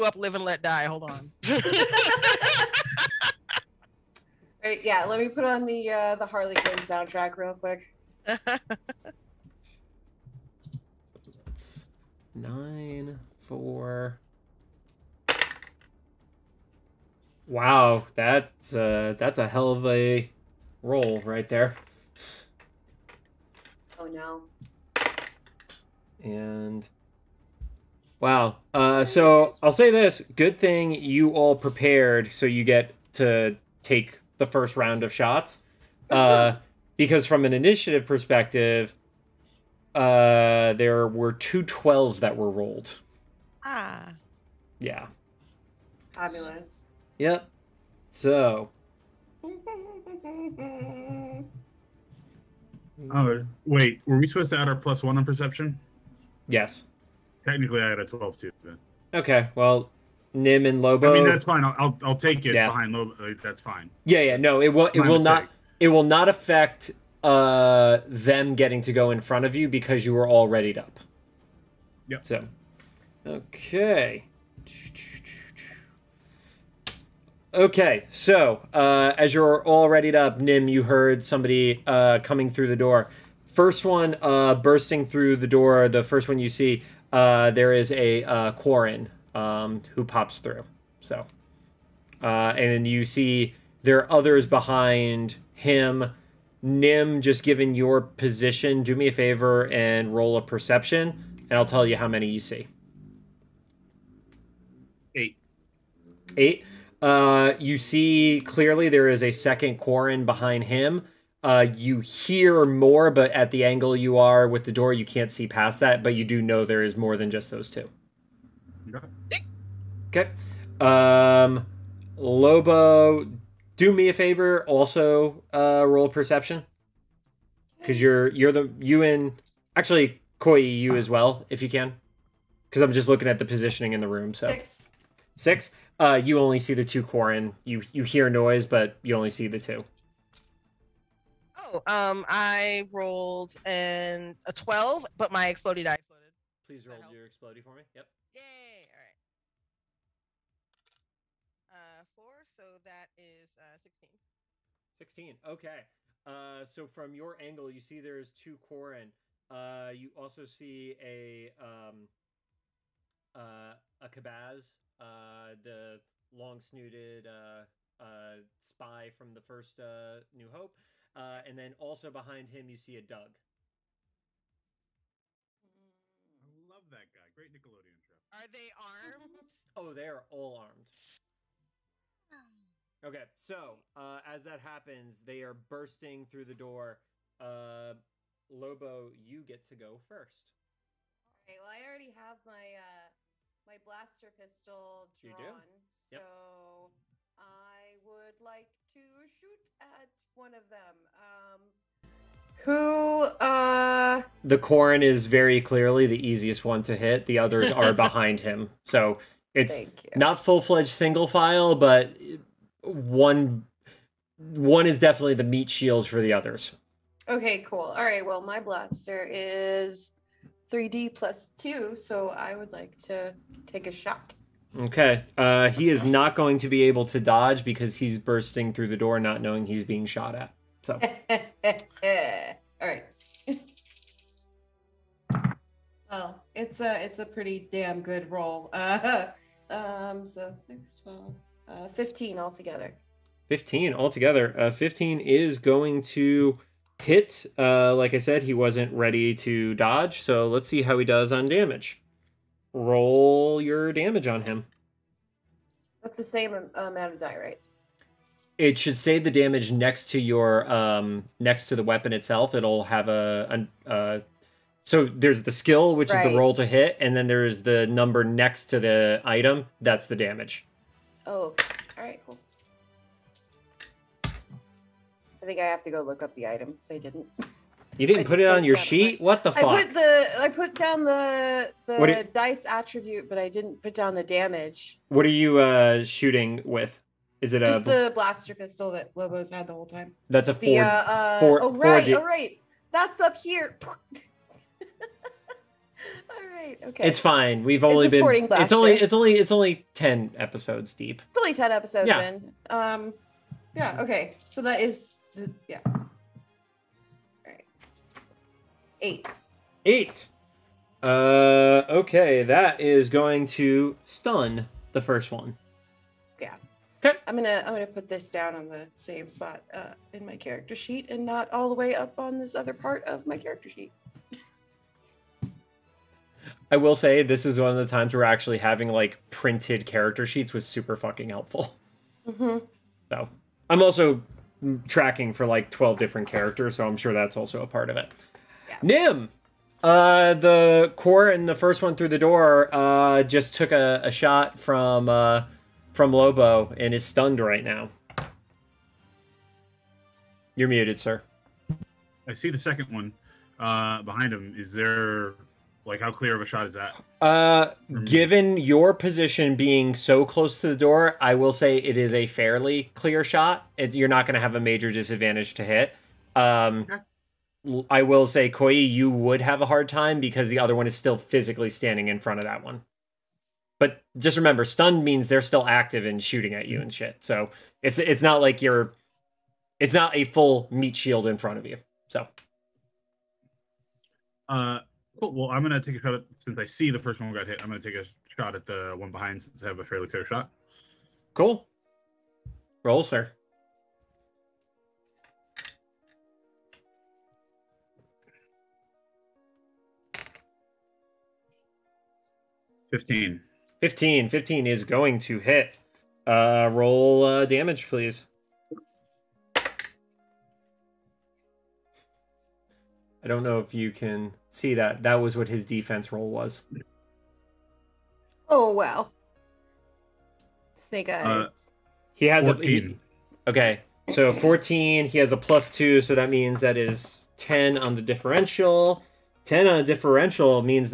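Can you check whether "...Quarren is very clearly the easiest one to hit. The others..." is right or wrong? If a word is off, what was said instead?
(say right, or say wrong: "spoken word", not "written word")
right.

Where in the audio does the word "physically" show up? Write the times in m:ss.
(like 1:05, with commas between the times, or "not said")
6:11.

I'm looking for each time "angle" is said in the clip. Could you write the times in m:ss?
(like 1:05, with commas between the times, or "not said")
1:53, 2:37.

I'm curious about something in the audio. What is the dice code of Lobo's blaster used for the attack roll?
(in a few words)
3d plus 2.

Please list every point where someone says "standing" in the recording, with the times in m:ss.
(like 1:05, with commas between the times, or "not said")
6:11.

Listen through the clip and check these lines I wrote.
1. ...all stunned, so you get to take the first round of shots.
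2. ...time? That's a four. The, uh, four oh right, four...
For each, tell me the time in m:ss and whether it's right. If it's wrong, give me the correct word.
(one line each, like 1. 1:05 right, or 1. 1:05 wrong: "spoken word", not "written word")
1. 0:31 wrong: "prepared", not "stunned"
2. 4:49 right.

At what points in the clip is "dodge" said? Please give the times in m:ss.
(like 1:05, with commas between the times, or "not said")
3:47, 4:09.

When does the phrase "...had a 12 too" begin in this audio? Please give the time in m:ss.
0:57.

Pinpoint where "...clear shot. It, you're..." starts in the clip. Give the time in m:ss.
6:02.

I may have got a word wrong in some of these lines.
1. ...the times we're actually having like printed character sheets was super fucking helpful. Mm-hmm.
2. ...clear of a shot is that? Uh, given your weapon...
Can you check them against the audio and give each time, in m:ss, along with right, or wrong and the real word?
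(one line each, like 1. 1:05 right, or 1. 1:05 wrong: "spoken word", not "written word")
1. 5:27 right
2. 5:56 wrong: "position", not "weapon".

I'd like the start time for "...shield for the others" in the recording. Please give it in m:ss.
3:35.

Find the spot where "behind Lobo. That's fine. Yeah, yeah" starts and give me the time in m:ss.
1:02.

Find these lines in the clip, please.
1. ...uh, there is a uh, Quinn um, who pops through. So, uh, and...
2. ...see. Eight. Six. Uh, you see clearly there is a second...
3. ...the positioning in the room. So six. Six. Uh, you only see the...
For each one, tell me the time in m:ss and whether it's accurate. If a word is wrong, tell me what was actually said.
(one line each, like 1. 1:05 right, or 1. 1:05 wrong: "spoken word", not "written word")
1. 1:27 wrong: "Quarren", not "Quinn"
2. 1:42 wrong: "Eight", not "Six"
3. 2:13 right.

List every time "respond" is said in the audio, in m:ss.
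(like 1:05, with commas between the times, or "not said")
not said.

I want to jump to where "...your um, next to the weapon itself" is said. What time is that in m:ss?
4:20.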